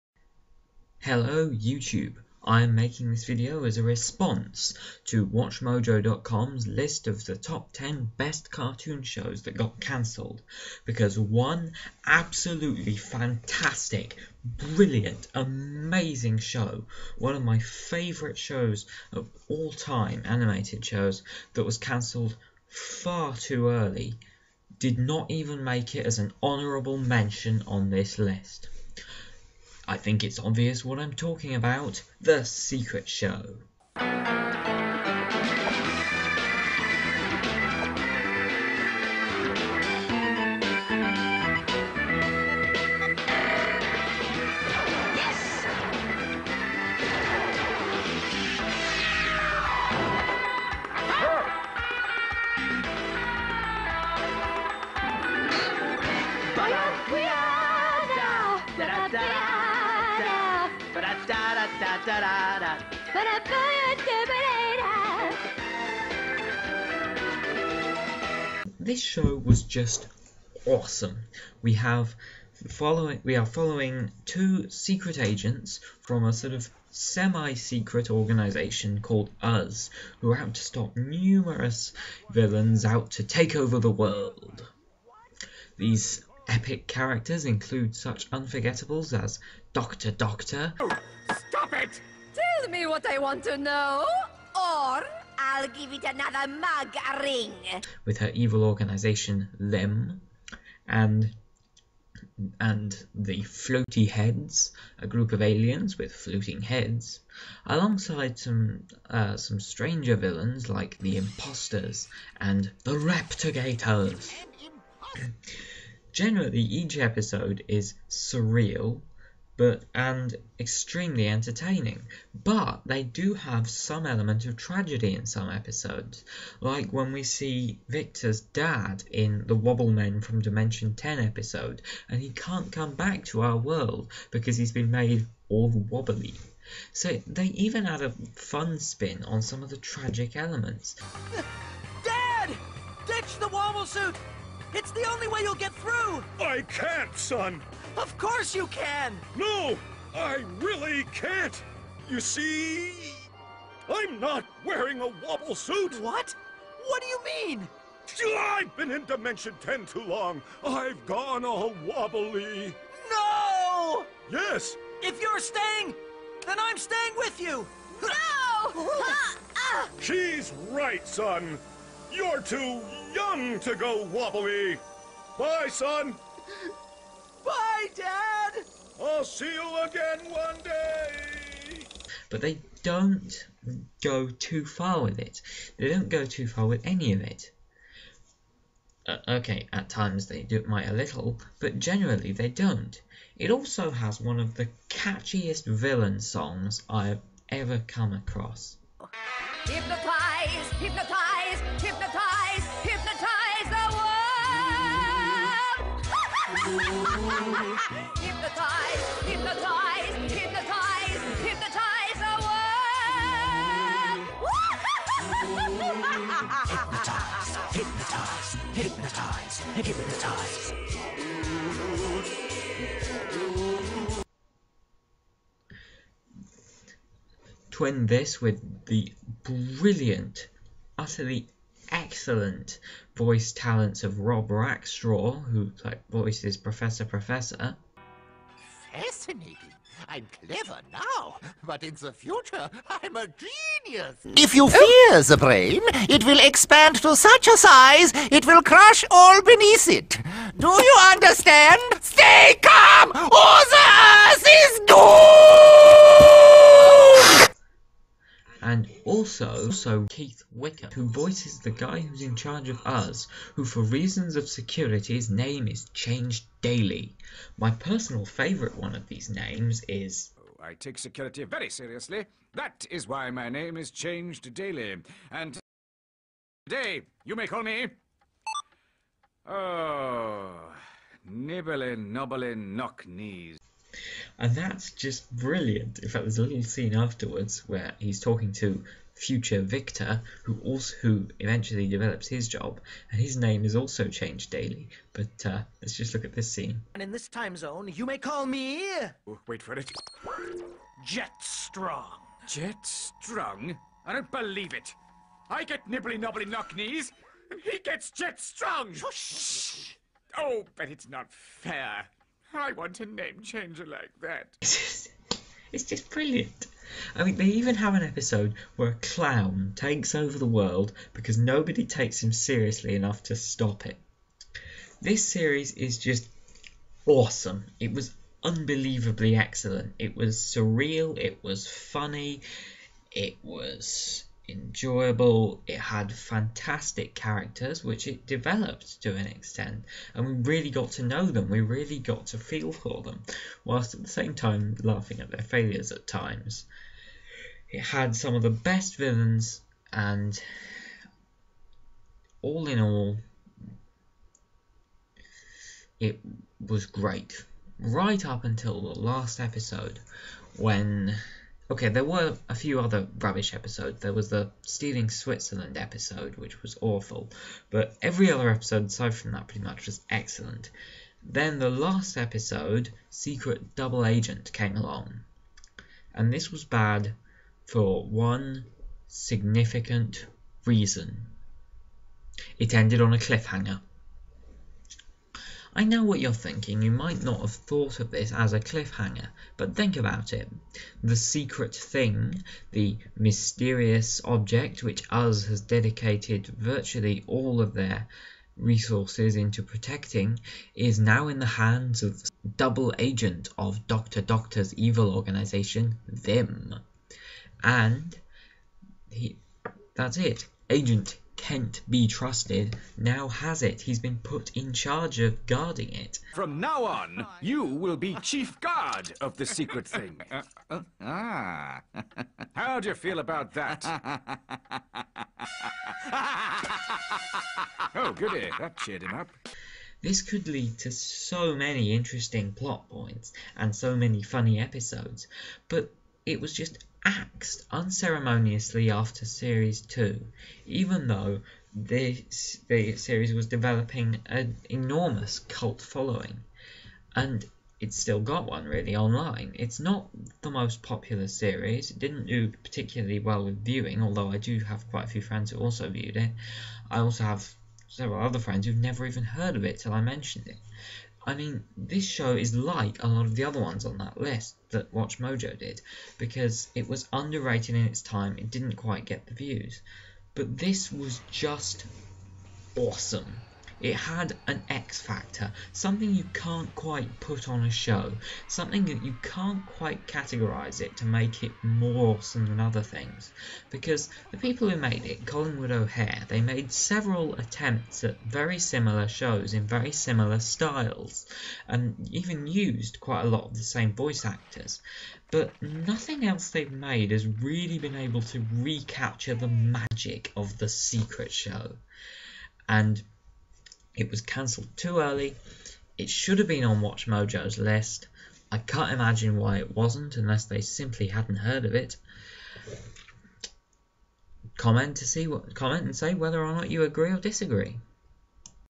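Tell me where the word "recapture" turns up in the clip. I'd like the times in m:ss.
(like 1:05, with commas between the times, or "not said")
8:18.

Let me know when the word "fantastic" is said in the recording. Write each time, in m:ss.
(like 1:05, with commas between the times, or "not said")
0:12, 5:36.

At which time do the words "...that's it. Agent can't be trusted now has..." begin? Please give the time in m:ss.
6:49.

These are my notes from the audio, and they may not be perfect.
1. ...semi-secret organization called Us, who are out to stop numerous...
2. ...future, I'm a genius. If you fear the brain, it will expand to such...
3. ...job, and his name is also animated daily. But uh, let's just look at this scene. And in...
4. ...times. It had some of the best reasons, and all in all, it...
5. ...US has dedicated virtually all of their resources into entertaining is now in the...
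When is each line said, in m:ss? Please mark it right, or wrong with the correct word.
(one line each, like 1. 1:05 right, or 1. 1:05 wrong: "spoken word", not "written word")
1. 1:16 right
2. 4:02 right
3. 4:52 wrong: "changed", not "animated"
4. 5:46 wrong: "villains", not "reasons"
5. 6:35 wrong: "protecting", not "entertaining".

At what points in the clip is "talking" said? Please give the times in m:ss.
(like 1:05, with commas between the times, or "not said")
0:31, 4:48.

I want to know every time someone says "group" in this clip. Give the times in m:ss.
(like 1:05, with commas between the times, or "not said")
1:45.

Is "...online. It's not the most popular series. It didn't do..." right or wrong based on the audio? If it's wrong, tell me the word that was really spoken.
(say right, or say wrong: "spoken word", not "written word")
right.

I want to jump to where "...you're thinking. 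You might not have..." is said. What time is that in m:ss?
6:26.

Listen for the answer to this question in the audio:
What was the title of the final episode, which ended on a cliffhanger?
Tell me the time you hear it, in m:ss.
6:13.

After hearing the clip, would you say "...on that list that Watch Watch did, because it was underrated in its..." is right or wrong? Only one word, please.
wrong.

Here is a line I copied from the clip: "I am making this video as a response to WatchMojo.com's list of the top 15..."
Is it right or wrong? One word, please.
wrong.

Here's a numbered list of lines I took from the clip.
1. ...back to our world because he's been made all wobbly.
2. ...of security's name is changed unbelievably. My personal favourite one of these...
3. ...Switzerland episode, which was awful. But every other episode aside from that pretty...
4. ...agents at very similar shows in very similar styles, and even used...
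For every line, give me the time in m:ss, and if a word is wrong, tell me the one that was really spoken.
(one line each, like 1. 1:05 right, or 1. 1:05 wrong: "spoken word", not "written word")
1. 2:12 right
2. 4:24 wrong: "daily", not "unbelievably"
3. 6:05 right
4. 8:07 wrong: "attempts", not "agents".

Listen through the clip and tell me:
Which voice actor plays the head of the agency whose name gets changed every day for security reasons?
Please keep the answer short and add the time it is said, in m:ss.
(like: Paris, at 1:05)
Keith Wickham, at 4:20.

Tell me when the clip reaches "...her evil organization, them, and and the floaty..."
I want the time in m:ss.
1:38.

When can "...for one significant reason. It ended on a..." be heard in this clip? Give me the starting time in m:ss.
6:17.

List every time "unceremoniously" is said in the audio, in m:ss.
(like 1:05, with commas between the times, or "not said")
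7:17.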